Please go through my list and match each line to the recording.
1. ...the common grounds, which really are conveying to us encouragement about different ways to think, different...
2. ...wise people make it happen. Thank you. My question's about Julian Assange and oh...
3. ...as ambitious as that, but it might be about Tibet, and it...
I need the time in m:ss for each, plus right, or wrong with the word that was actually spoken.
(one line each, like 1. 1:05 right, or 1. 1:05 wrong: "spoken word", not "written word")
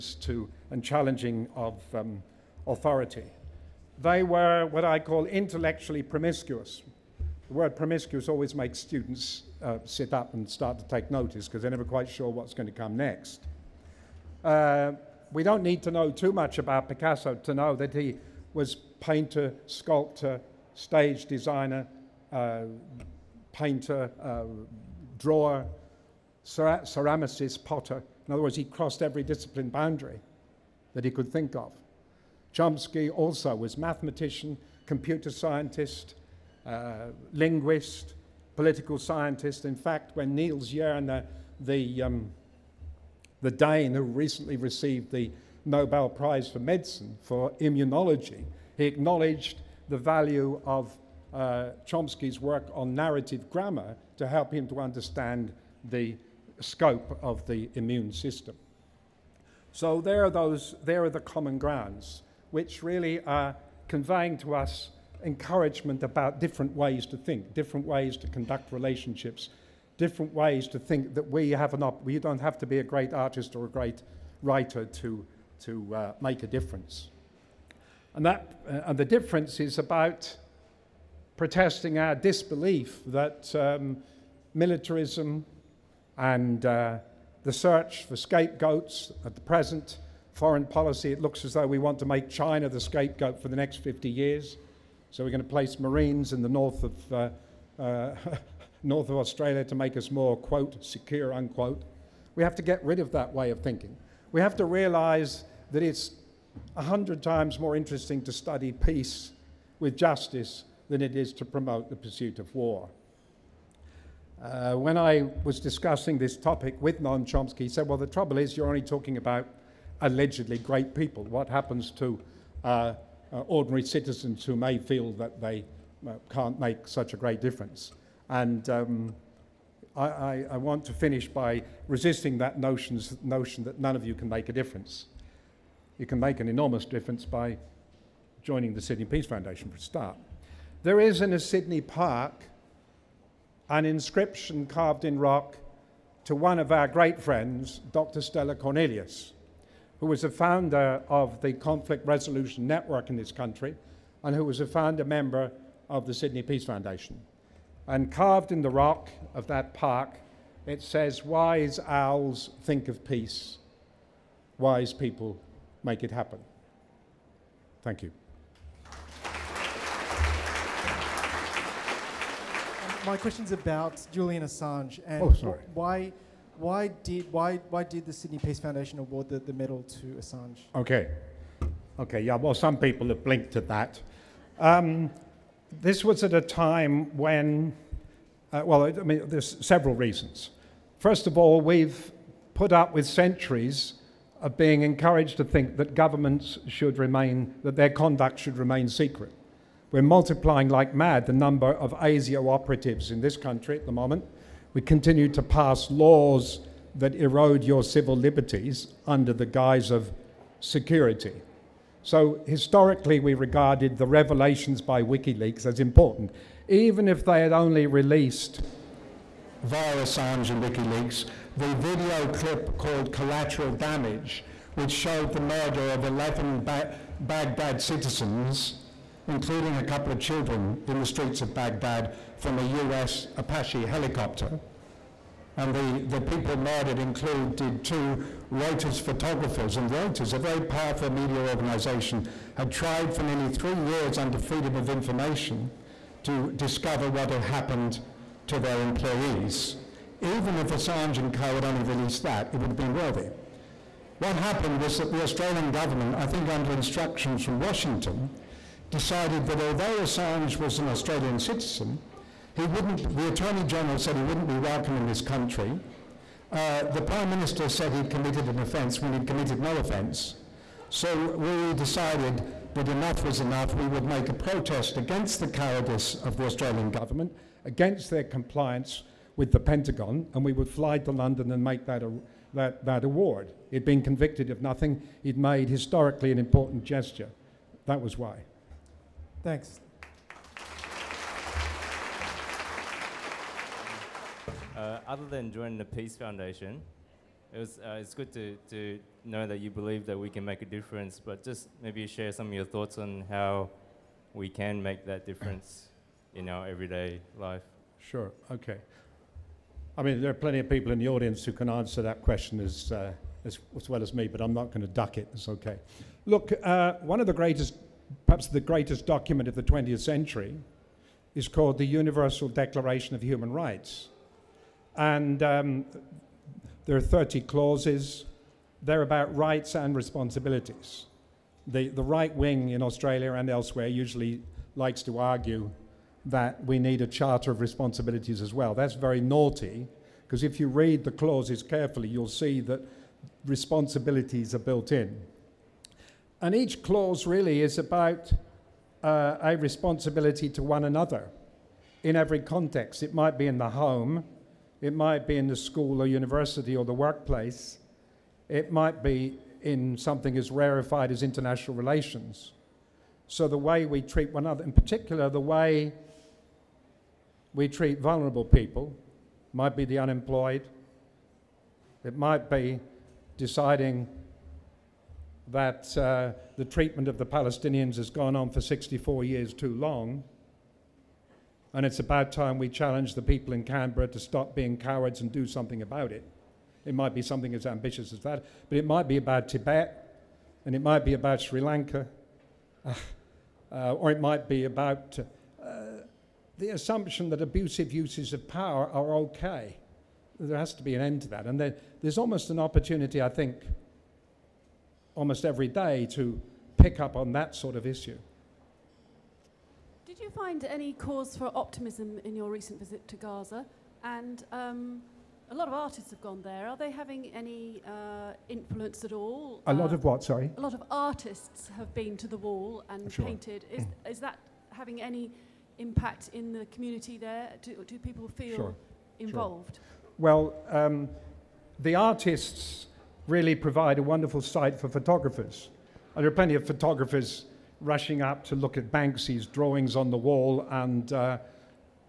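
1. 1:01 right
2. 2:44 right
3. 6:27 right.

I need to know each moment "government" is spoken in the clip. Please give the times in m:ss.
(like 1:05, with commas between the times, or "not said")
3:15, 4:15, 4:36.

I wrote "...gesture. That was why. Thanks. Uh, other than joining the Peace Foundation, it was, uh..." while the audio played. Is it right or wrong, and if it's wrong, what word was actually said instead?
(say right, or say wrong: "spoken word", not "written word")
right.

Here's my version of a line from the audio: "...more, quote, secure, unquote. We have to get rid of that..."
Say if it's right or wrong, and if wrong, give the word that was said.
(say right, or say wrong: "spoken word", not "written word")
right.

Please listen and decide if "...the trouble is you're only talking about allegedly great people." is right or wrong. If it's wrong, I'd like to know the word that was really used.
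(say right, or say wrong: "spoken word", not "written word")
right.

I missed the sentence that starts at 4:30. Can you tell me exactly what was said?
So we decided that enough was enough.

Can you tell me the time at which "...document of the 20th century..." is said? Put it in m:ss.
5:19.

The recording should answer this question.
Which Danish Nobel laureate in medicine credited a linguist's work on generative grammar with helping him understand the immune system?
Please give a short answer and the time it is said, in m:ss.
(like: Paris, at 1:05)
Niels Jerne, at 0:40.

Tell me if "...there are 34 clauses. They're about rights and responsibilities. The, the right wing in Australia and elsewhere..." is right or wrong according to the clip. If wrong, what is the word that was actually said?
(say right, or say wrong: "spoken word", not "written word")
wrong: "30", not "34".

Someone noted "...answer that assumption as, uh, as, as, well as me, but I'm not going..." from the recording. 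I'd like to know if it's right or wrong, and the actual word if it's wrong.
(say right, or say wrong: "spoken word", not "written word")
wrong: "question", not "assumption".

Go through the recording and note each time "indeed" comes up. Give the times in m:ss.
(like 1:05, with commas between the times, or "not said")
not said.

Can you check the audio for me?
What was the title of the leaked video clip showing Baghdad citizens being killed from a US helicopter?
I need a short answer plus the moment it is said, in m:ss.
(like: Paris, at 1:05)
Collateral Damage, at 3:43.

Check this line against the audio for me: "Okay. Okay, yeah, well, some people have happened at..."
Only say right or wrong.
wrong.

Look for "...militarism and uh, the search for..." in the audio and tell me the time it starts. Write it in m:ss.
1:24.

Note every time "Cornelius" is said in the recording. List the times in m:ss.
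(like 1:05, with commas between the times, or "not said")
2:28.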